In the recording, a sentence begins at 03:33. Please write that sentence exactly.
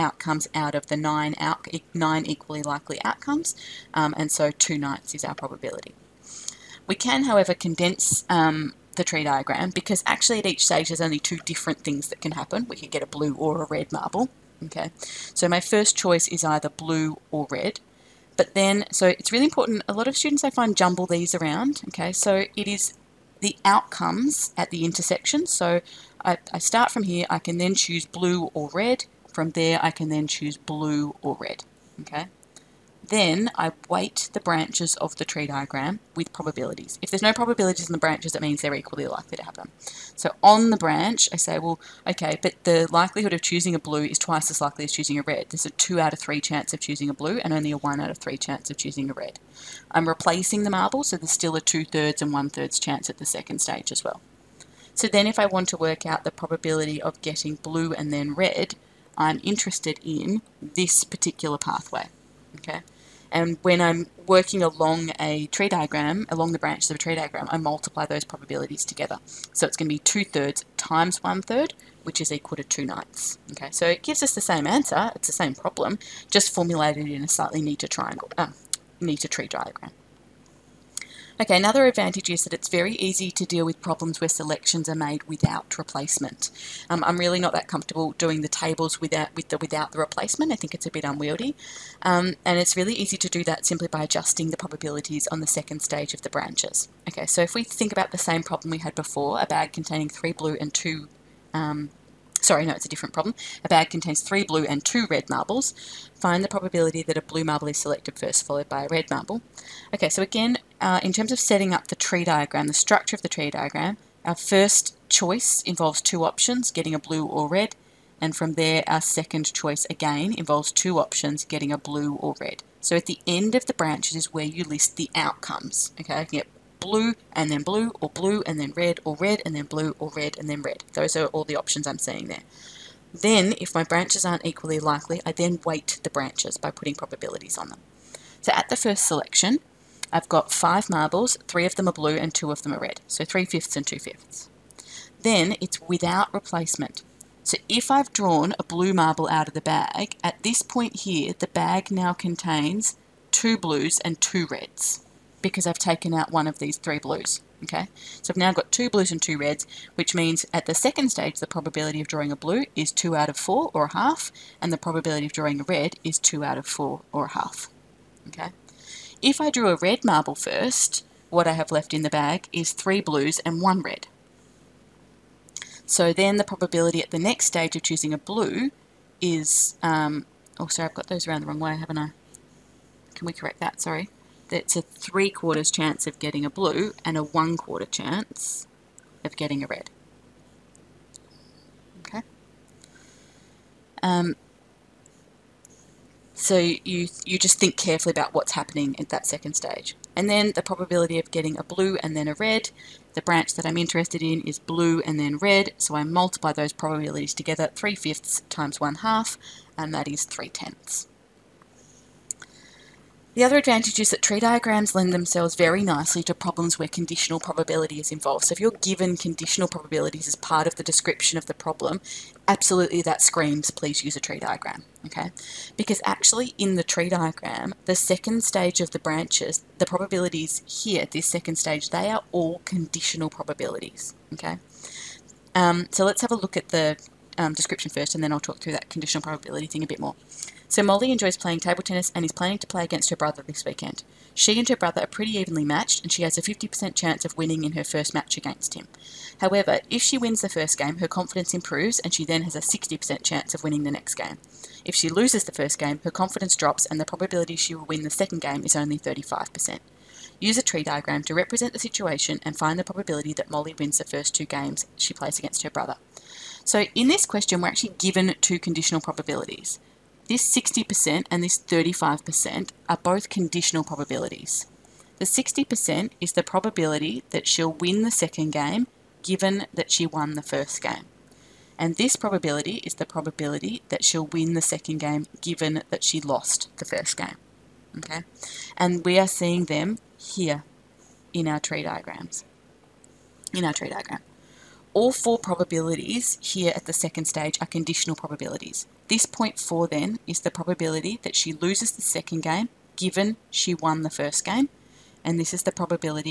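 The other advantage is that tree diagrams lend themselves very nicely to problems where conditional probability is involved.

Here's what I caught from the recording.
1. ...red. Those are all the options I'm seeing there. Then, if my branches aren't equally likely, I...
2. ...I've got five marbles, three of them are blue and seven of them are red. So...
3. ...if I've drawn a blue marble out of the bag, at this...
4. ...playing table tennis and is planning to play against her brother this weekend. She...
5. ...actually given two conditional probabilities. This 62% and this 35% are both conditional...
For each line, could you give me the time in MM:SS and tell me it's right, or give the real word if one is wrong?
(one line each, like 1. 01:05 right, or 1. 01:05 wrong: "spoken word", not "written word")
1. 02:10 right
2. 02:20 wrong: "two", not "seven"
3. 02:27 right
4. 04:01 right
5. 04:27 wrong: "60", not "62".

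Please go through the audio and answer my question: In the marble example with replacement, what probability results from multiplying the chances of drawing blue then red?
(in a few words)
2/9.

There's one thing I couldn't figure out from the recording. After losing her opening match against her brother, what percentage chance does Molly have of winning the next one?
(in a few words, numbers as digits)
35%.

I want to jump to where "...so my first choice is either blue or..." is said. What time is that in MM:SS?
00:15.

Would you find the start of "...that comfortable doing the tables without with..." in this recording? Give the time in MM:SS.
01:27.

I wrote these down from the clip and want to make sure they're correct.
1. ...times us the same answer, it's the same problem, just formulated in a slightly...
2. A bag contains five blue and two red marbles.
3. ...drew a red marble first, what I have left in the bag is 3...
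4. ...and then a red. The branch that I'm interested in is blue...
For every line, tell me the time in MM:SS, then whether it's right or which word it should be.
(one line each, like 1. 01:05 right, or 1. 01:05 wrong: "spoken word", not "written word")
1. 01:14 wrong: "gives", not "times"
2. 01:43 wrong: "three", not "five"
3. 02:49 right
4. 03:22 right.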